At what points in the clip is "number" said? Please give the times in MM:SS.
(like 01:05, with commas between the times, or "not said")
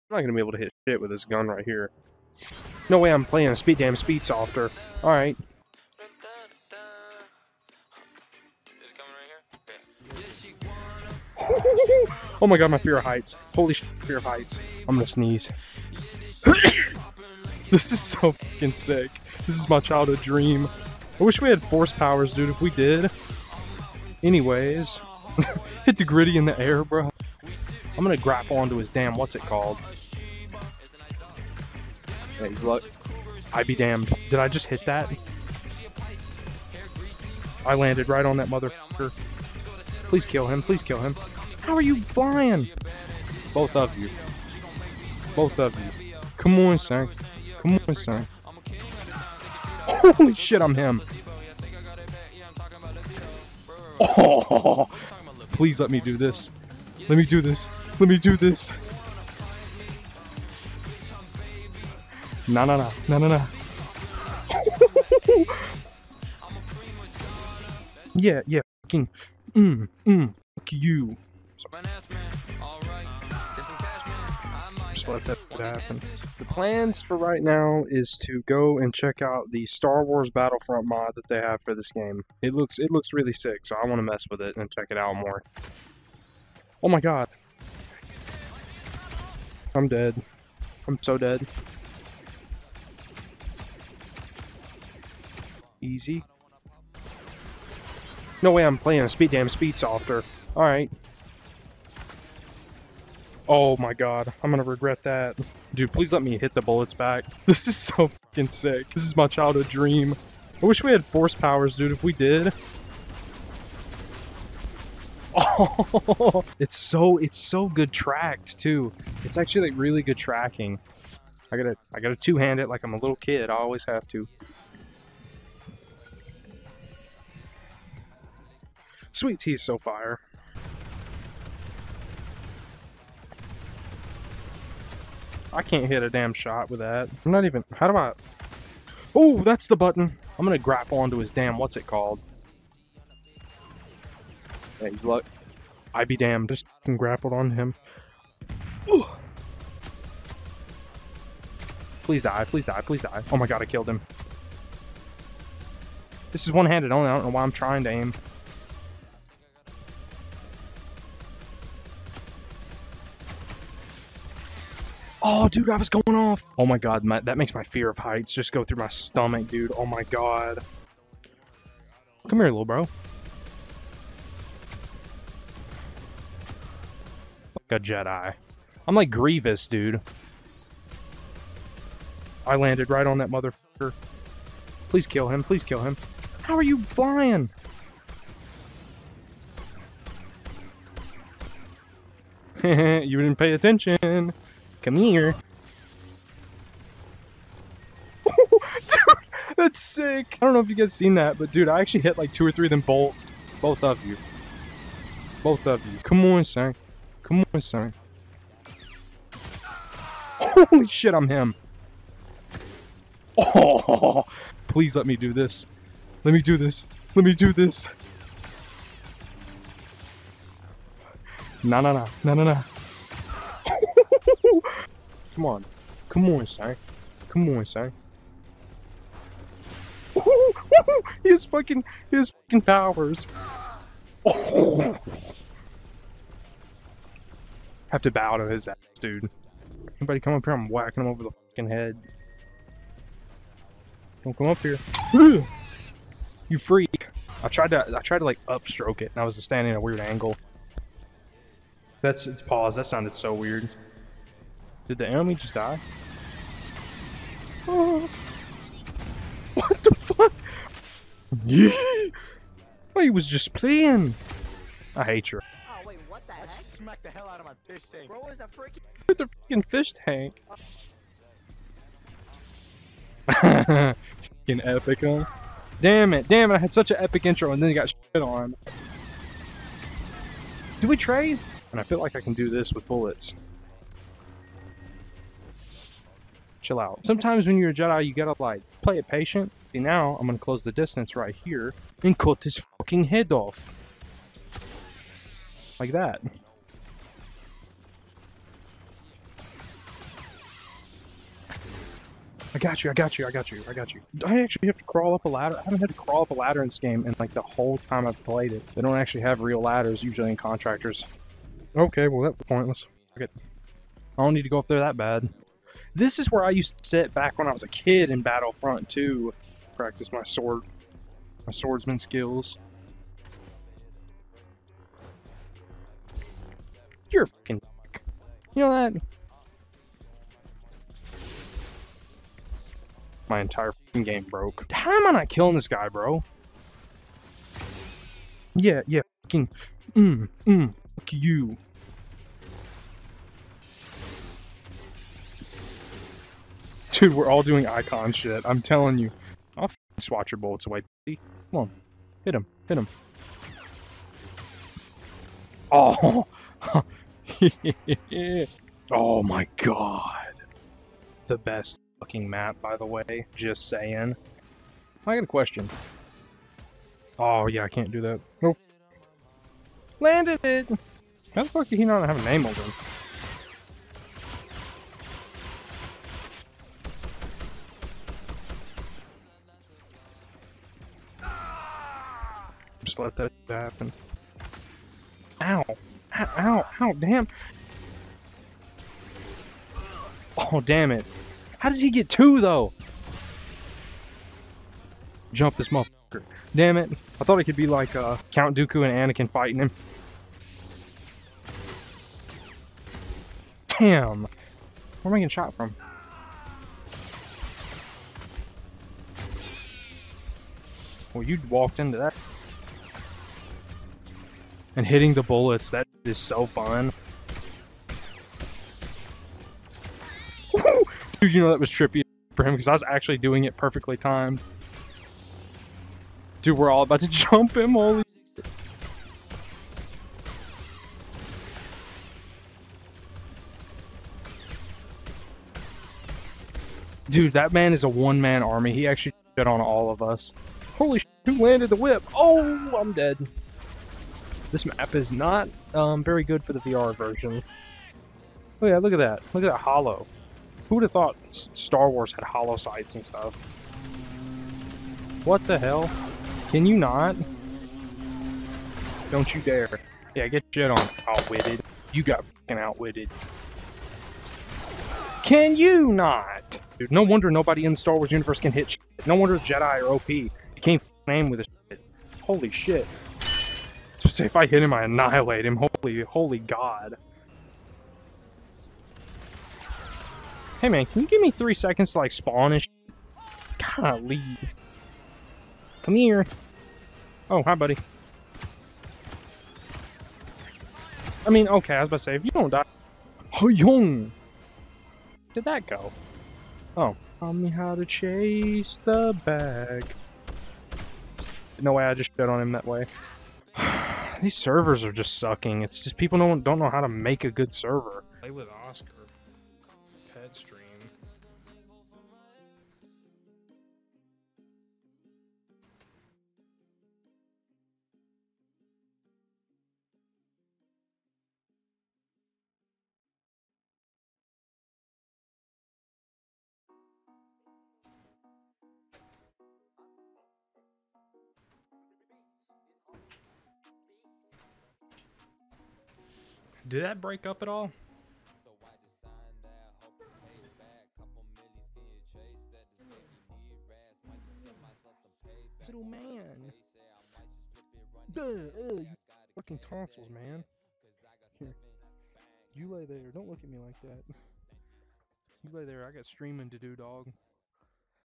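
not said.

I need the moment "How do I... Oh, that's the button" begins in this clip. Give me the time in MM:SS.
02:17.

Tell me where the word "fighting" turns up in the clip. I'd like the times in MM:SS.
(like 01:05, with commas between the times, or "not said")
06:39.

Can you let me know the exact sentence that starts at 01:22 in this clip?
It looks it looks really sick, so I want to mess with it and check it out more.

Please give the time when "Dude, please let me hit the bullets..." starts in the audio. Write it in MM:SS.
01:45.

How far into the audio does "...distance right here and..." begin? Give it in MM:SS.
04:50.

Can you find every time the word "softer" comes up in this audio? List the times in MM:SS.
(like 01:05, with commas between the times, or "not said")
00:04, 01:39.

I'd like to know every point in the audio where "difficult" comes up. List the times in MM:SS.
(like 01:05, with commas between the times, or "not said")
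not said.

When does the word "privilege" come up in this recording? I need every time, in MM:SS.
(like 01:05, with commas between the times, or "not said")
not said.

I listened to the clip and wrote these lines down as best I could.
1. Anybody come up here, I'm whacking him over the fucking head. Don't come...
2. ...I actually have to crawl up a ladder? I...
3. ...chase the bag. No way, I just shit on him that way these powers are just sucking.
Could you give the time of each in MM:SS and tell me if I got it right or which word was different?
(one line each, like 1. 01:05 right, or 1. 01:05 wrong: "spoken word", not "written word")
1. 03:59 right
2. 05:04 right
3. 08:17 wrong: "servers", not "powers".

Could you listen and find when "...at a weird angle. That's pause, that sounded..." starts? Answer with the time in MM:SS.
04:09.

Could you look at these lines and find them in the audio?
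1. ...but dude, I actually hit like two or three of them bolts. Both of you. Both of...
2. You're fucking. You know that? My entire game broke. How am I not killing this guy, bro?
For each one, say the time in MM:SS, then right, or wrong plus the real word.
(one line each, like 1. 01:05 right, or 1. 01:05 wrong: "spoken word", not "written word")
1. 03:21 right
2. 05:27 right.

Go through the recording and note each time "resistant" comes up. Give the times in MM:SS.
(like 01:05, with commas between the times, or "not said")
not said.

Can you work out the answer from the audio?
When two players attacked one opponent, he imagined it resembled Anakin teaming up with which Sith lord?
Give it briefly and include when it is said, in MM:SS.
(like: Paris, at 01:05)
Count Dooku, at 06:38.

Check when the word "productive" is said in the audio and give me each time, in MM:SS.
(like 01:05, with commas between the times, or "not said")
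not said.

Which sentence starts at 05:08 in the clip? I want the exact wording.
They don't actually have real ladders usually in contractors.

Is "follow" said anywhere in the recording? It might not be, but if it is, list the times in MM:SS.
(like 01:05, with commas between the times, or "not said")
not said.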